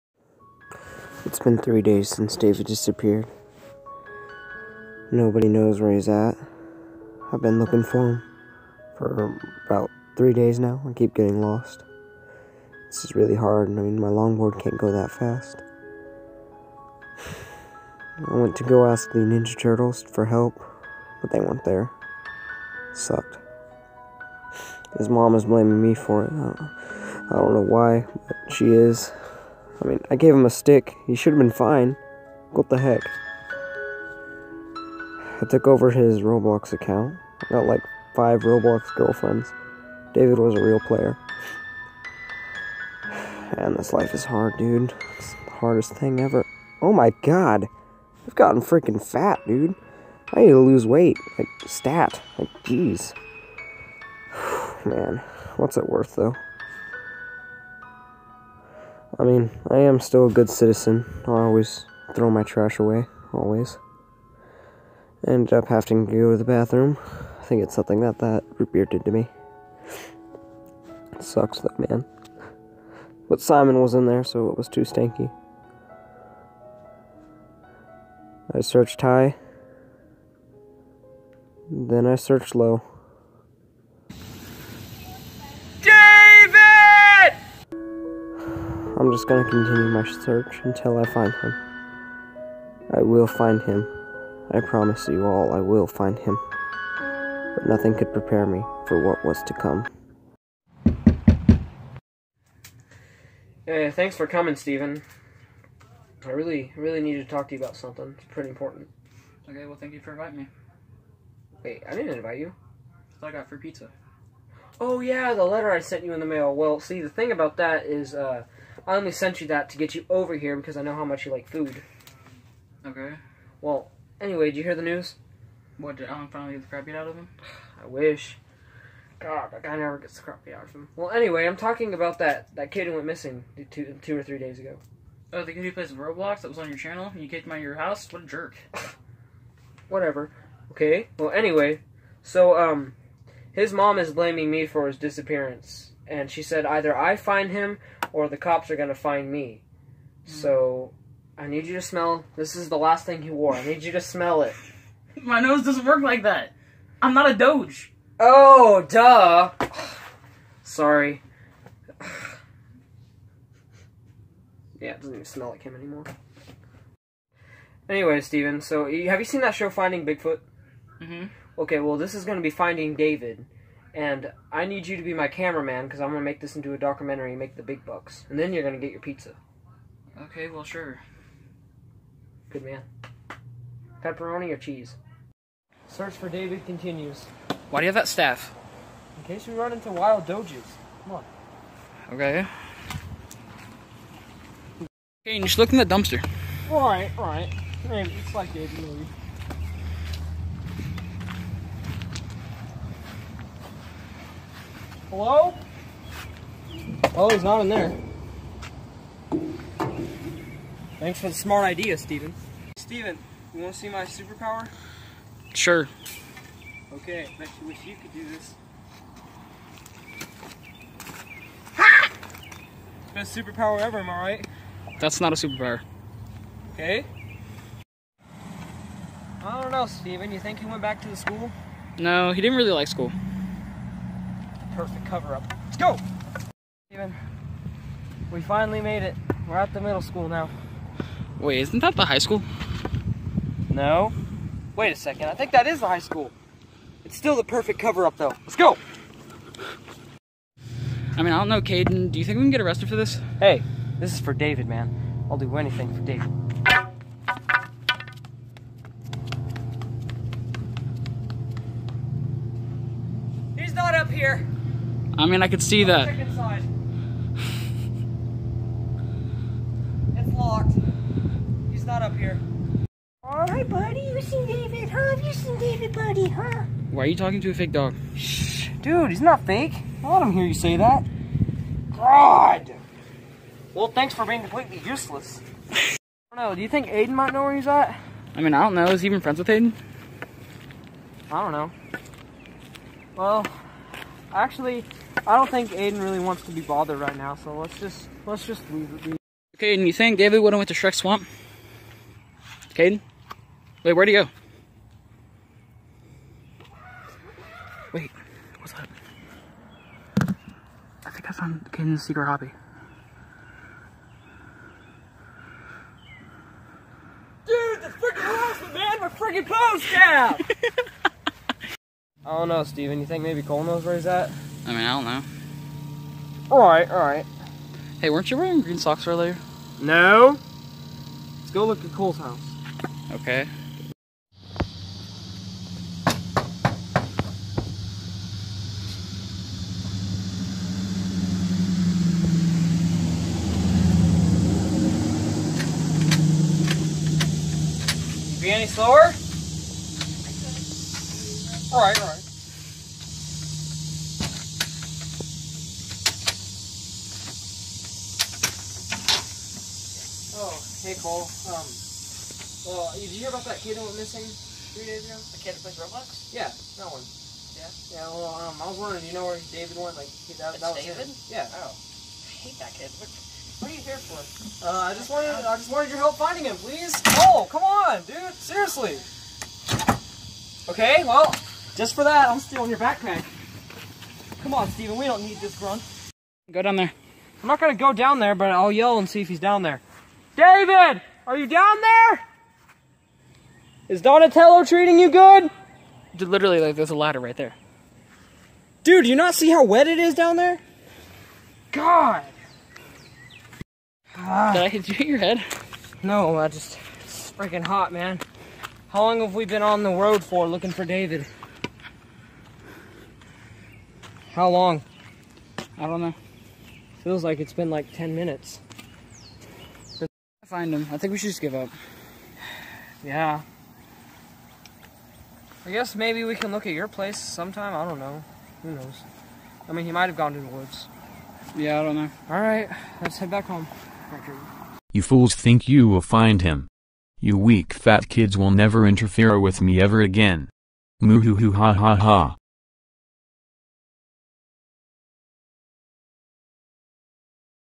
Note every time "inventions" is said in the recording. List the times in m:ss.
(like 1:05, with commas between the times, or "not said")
not said.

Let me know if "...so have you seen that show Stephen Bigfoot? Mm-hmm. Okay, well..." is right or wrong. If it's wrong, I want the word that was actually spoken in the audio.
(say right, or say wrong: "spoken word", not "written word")
wrong: "Finding", not "Stephen".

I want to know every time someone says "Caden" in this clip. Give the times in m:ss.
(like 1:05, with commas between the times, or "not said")
4:11, 5:02, 5:11.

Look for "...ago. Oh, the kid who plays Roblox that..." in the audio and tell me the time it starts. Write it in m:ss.
2:14.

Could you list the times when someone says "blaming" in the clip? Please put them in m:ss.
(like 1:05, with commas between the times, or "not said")
0:25, 2:24.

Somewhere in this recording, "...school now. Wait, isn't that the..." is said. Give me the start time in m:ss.
4:00.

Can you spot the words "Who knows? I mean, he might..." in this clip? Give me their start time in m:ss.
7:08.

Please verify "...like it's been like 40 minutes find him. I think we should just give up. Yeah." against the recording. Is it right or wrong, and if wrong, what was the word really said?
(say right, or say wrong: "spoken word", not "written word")
wrong: "10", not "40".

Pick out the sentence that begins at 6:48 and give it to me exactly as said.
How long have we been on the road for looking for David?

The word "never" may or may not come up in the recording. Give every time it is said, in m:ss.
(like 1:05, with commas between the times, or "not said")
2:09, 7:18.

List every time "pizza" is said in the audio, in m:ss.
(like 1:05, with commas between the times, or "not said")
1:53, 2:58.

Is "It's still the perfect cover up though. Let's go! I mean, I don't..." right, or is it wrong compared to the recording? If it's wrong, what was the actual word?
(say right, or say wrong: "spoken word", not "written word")
right.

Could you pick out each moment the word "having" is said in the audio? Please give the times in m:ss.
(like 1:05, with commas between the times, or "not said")
1:05.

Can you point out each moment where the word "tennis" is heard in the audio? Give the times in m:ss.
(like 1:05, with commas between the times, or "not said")
not said.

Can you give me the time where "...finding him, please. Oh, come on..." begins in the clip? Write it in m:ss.
6:16.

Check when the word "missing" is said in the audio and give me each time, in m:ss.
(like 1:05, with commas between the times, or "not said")
2:13, 6:03.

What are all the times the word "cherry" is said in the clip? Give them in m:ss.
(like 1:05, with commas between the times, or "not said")
not said.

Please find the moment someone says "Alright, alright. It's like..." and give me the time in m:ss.
3:16.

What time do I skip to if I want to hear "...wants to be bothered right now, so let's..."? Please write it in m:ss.
4:56.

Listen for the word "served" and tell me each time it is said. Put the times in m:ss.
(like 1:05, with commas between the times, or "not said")
not said.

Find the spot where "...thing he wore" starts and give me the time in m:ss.
2:33.